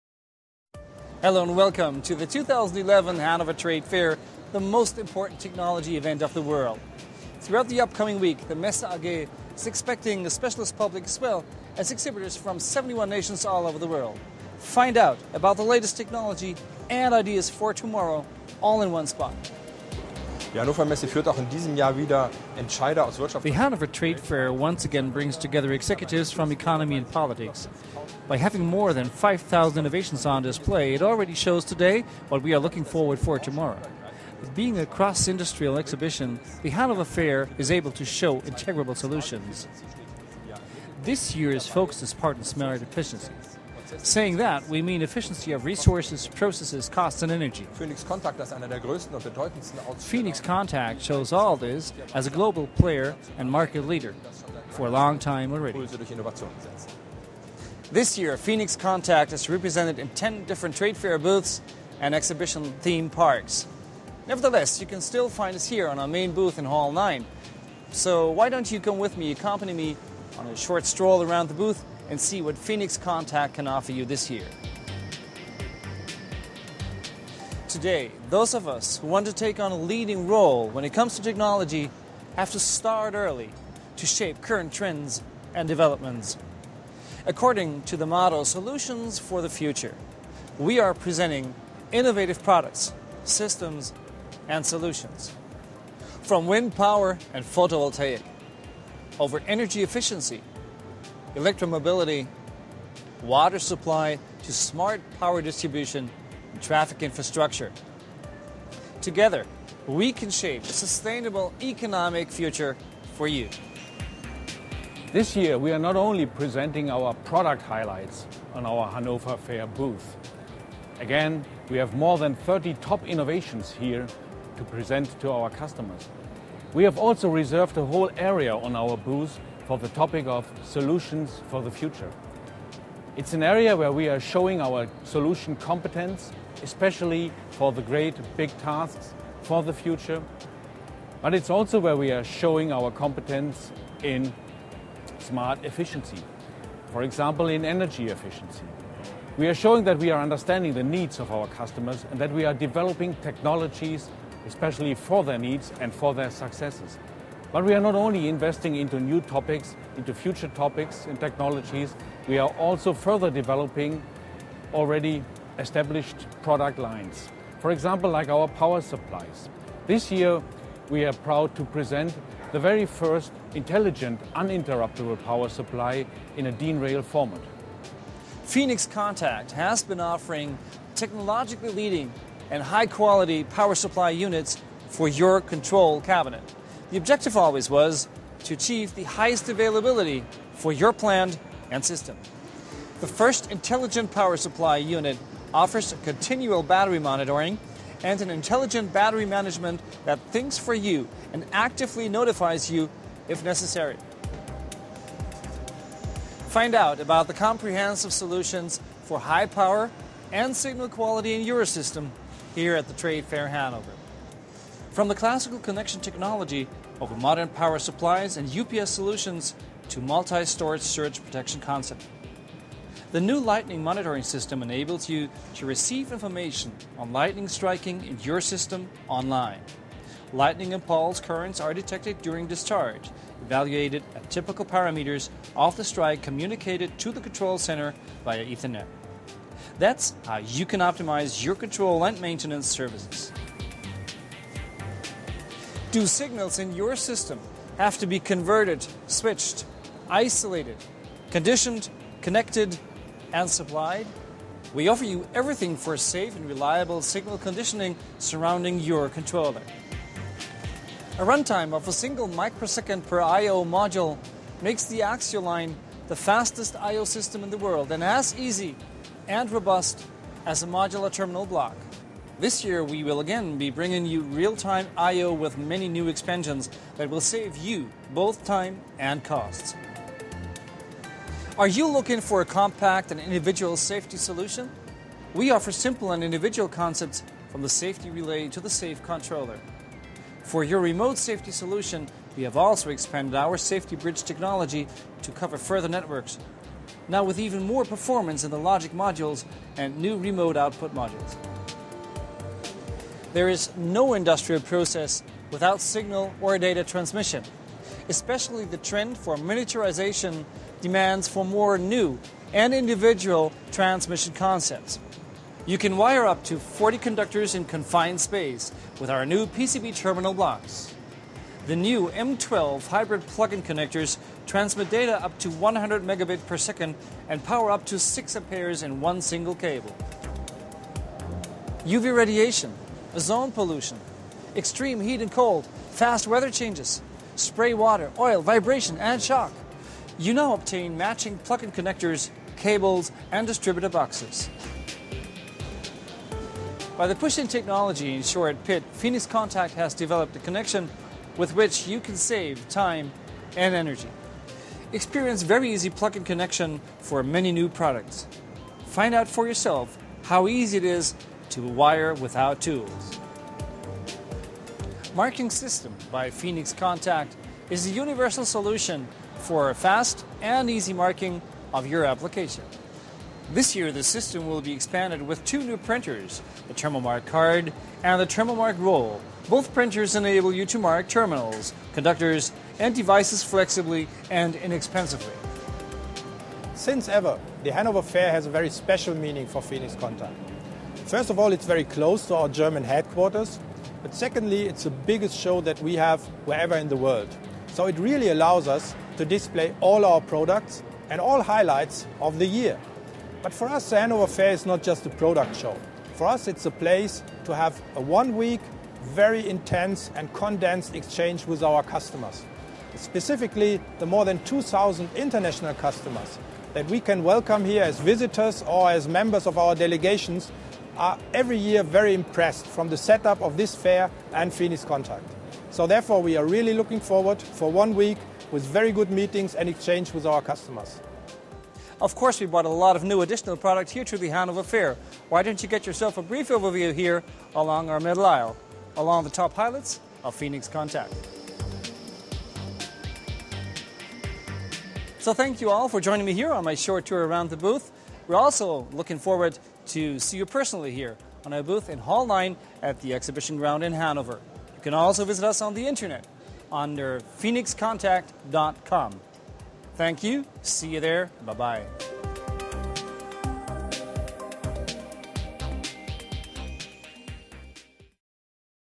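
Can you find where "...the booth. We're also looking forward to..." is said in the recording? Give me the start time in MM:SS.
07:27.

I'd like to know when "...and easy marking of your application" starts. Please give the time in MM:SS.
06:10.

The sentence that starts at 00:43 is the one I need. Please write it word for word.
Saying that, we mean efficiency of resources, processes, costs, and energy.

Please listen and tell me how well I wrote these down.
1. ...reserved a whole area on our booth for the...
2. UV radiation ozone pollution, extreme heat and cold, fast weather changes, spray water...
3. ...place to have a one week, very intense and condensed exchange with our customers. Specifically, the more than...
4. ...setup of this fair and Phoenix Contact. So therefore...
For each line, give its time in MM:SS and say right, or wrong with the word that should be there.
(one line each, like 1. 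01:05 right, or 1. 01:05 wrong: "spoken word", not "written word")
1. 02:07 right
2. 05:31 right
3. 06:46 right
4. 07:02 right.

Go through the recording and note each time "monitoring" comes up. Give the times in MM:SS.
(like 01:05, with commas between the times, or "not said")
03:16, 03:43.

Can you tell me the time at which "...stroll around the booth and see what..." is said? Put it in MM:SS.
01:10.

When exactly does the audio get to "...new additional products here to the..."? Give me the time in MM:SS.
07:13.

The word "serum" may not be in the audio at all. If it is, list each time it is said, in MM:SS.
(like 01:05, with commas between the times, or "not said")
not said.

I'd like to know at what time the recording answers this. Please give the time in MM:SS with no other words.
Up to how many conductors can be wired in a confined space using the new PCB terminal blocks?
05:16.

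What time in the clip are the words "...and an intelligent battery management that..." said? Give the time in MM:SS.
03:18.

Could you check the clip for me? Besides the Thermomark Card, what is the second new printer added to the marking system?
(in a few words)
Thermomark Roll.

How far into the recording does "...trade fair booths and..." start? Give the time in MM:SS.
01:00.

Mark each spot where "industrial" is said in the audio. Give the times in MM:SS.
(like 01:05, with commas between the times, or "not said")
00:35, 05:04.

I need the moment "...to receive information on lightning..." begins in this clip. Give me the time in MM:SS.
03:45.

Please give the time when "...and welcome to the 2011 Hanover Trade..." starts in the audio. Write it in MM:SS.
00:01.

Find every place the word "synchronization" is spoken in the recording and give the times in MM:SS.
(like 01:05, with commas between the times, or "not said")
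not said.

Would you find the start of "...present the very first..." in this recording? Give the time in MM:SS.
02:51.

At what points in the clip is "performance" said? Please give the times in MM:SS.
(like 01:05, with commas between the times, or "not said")
04:57.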